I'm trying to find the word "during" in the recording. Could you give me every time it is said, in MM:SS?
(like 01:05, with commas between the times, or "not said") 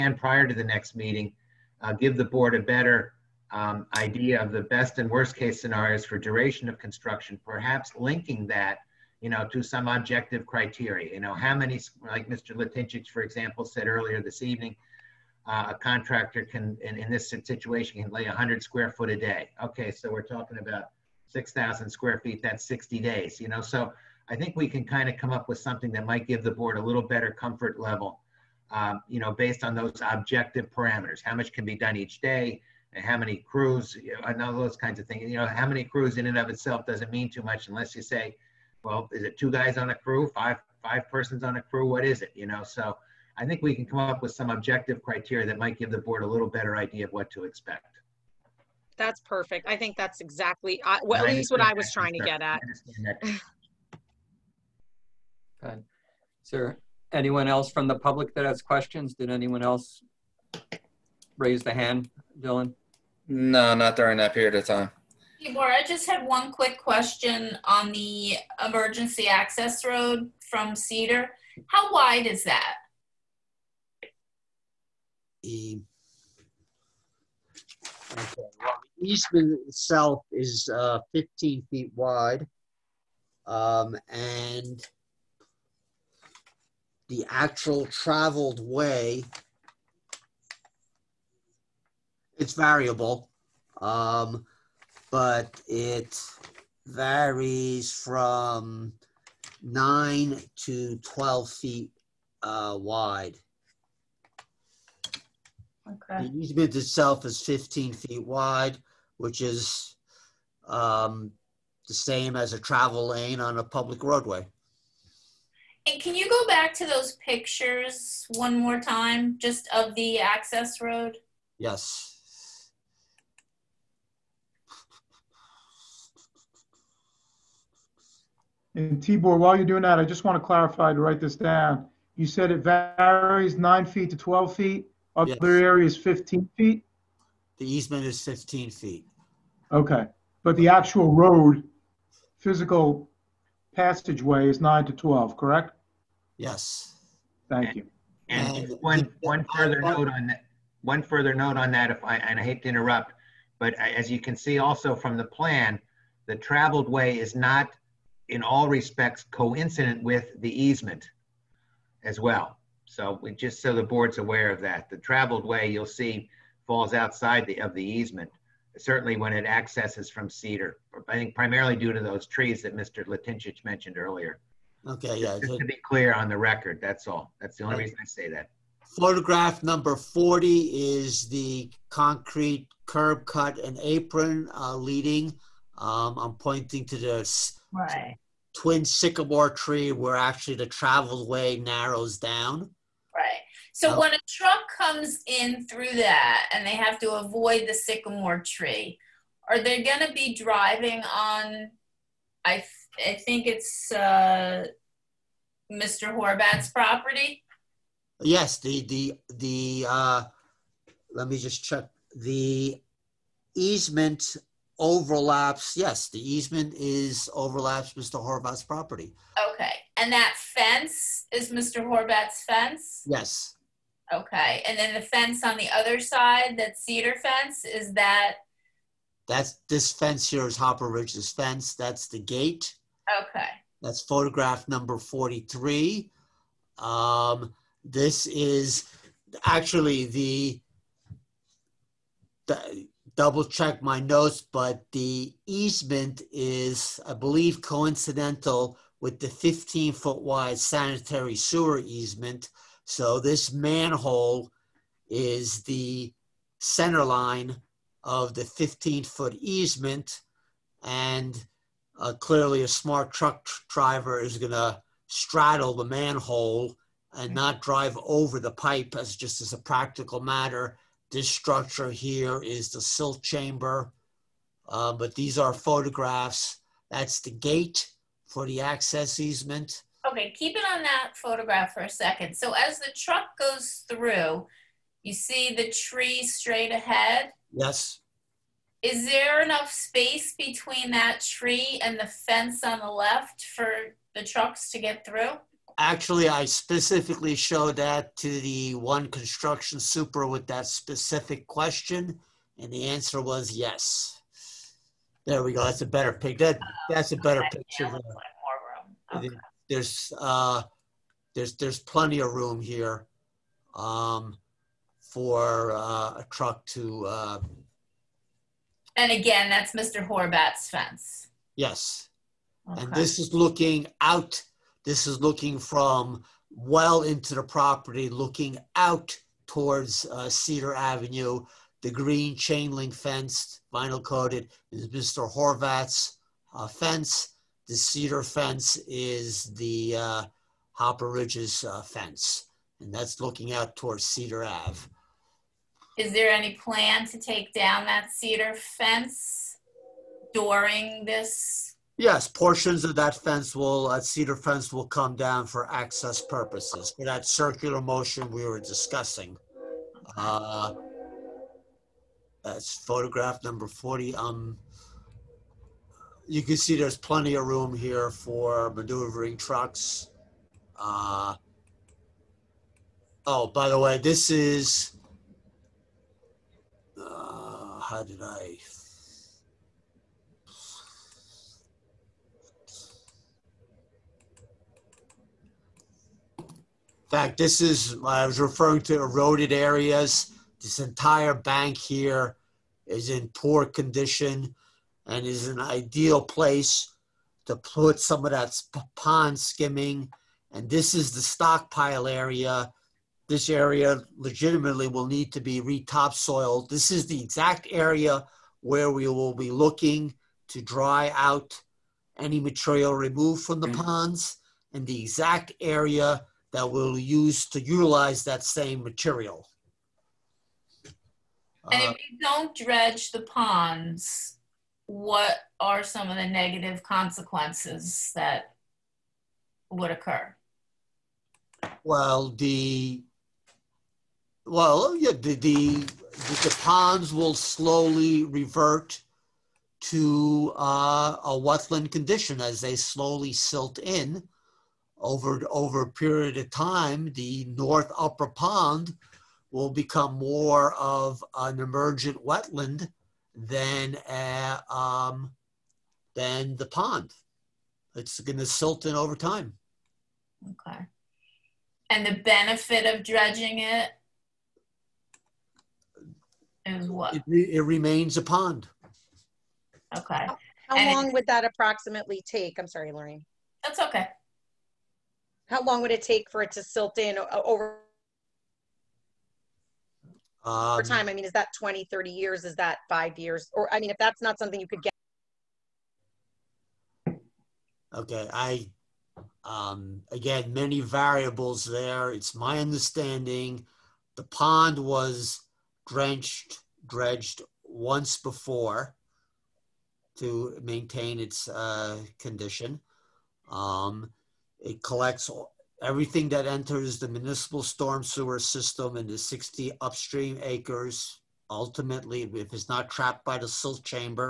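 01:03, 05:50.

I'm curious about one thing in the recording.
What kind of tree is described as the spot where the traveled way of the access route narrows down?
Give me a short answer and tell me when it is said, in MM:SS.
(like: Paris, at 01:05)
twin sycamore, at 03:08.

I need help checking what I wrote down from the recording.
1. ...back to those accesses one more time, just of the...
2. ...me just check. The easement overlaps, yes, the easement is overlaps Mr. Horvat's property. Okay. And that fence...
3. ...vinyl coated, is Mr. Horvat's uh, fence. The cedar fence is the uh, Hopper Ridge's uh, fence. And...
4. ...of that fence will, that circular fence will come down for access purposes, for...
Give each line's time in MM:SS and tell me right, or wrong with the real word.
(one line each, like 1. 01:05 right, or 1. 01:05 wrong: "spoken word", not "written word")
1. 01:56 wrong: "pictures", not "accesses"
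2. 03:31 right
3. 05:33 right
4. 05:52 wrong: "cedar", not "circular".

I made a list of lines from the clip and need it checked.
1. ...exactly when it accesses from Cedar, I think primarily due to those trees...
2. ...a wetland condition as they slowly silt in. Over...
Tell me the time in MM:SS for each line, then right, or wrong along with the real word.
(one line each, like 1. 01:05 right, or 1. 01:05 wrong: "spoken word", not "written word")
1. 02:48 wrong: "certainly", not "exactly"
2. 07:21 right.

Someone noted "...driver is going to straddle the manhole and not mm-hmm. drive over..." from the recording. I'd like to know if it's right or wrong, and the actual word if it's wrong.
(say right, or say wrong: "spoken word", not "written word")
right.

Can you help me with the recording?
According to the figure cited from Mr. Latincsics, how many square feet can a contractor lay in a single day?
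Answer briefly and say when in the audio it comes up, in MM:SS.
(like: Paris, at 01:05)
100 square feet, at 00:18.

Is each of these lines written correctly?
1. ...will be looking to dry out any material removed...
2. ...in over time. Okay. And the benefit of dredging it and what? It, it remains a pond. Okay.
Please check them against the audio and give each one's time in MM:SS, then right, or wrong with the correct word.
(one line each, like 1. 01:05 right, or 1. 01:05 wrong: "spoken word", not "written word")
1. 06:49 right
2. 07:38 right.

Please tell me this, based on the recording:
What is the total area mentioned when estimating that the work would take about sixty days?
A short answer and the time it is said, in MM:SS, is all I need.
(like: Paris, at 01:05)
6,000 square feet, at 00:21.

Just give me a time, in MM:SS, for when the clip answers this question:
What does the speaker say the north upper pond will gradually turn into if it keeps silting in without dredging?
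07:31.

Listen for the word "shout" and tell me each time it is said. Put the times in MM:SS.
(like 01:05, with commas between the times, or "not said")
not said.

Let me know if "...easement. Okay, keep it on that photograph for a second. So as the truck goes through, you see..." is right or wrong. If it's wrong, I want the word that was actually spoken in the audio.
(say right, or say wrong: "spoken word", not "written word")
right.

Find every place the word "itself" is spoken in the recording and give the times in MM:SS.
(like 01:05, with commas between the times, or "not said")
00:36, 01:19, 01:46.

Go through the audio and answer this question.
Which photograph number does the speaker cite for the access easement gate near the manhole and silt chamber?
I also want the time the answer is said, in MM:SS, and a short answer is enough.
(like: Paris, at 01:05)
43, at 03:54.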